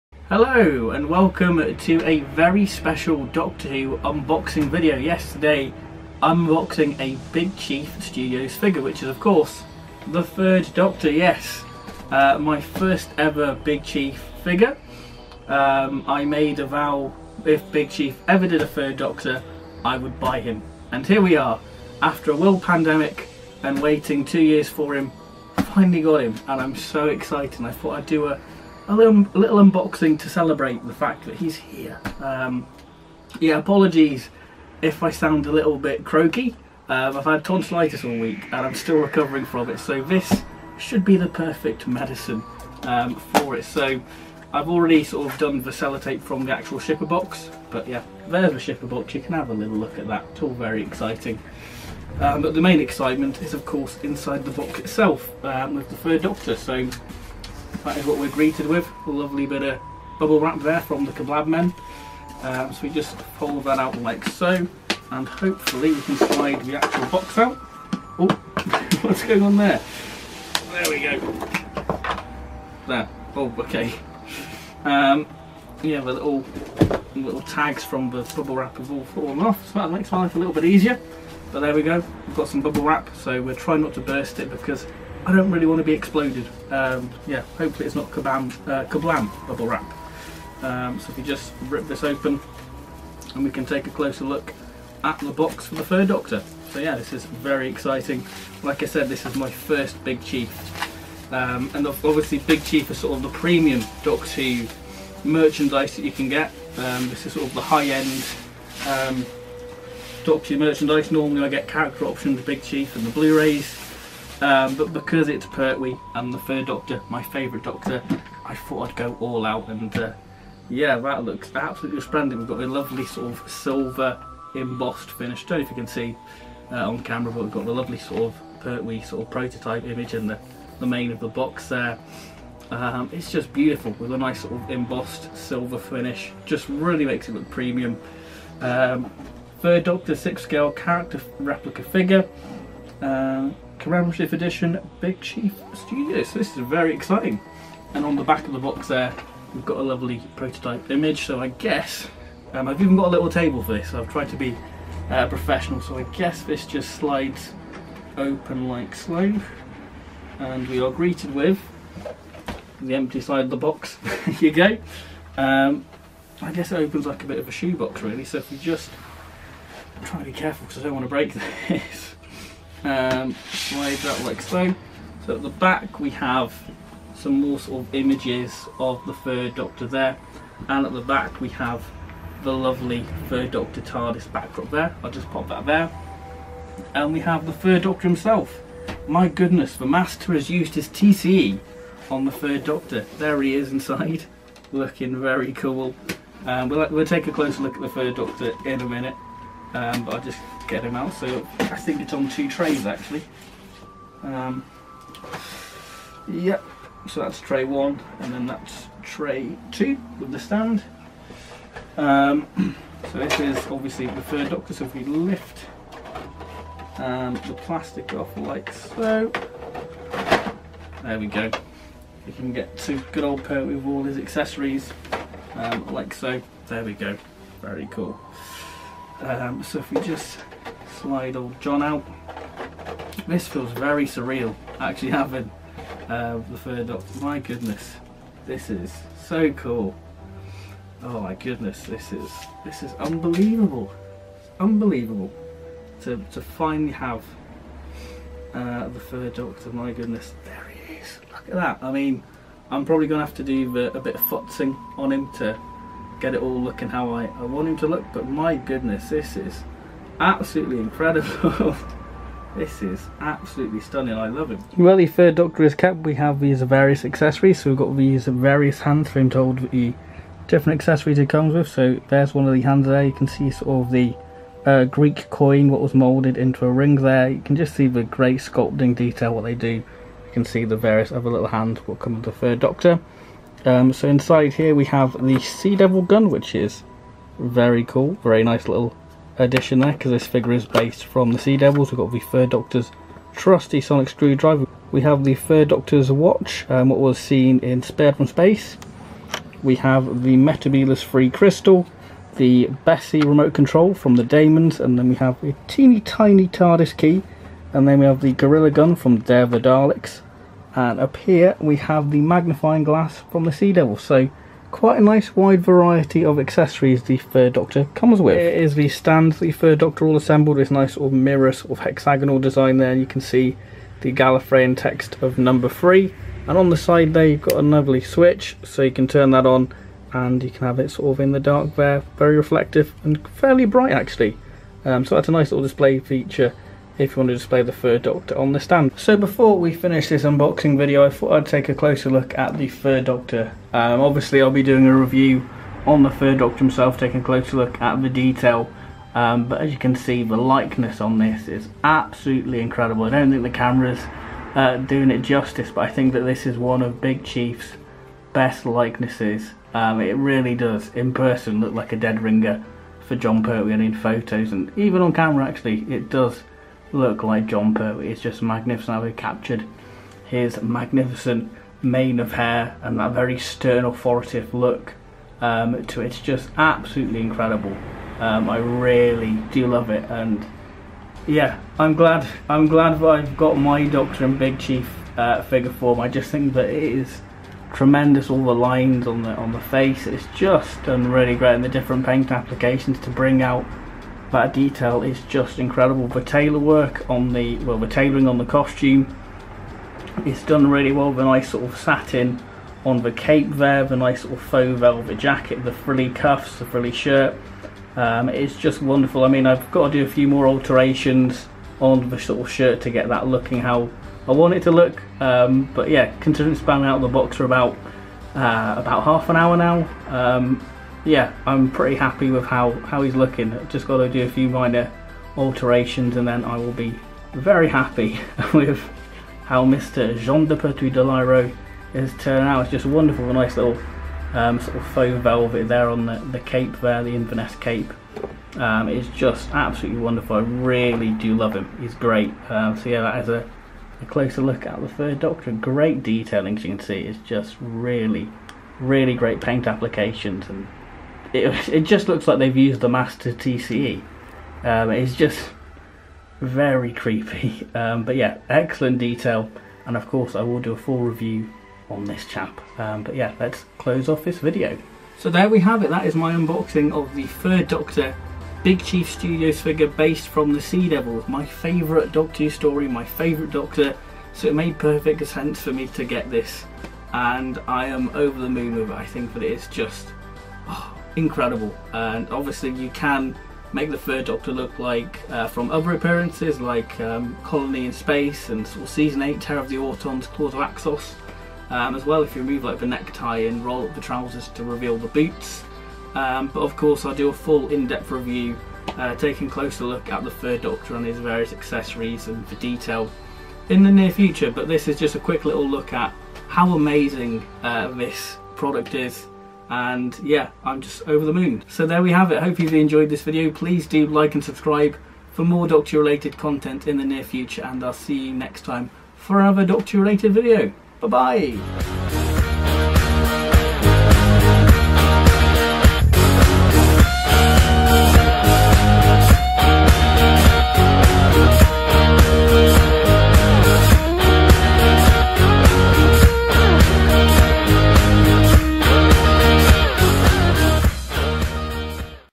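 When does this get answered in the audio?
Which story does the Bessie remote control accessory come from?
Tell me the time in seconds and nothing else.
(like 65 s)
304 s.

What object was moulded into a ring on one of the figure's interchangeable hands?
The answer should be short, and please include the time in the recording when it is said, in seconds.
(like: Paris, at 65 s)
Greek coin, at 274 s.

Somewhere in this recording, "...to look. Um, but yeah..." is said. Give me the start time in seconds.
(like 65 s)
414 s.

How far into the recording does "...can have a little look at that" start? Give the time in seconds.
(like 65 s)
49 s.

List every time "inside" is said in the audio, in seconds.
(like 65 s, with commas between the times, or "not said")
54 s, 193 s, 284 s.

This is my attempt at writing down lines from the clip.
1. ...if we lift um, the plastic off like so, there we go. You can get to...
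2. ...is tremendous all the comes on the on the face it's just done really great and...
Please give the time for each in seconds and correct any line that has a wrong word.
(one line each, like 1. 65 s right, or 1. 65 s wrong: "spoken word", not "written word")
1. 214 s right
2. 386 s wrong: "lines", not "comes".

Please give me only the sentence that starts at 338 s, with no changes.
So before we finish this unboxing video I thought I'd take a closer look at the Fur Doctor.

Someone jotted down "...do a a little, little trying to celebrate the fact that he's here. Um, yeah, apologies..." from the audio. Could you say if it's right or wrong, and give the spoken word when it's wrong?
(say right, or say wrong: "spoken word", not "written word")
wrong: "unboxing", not "trying".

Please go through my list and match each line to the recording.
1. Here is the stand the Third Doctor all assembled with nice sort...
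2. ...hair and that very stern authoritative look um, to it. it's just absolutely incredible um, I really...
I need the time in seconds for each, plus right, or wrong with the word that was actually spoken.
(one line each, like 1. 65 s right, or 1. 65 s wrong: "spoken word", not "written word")
1. 318 s right
2. 372 s right.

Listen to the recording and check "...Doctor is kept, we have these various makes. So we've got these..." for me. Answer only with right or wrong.
wrong.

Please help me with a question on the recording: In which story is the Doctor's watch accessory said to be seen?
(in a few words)
Spearhead from Space.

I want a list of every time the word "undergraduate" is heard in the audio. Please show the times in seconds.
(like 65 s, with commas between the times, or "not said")
not said.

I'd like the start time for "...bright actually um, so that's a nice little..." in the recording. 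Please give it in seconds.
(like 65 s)
333 s.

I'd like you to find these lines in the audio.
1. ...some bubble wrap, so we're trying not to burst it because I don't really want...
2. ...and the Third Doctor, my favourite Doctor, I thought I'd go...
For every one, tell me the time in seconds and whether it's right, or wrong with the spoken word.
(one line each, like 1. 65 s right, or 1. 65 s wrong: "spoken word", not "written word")
1. 82 s right
2. 116 s right.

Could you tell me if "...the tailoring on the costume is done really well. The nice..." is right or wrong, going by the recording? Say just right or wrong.
right.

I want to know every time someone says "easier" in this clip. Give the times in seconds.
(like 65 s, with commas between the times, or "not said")
80 s.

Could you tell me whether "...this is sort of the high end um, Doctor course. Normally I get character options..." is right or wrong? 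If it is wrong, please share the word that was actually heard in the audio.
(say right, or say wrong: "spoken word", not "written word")
wrong: "merchandise", not "course".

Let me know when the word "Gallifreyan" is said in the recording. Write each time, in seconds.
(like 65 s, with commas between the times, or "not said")
324 s.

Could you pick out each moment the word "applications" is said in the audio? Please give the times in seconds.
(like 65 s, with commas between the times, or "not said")
392 s, 449 s.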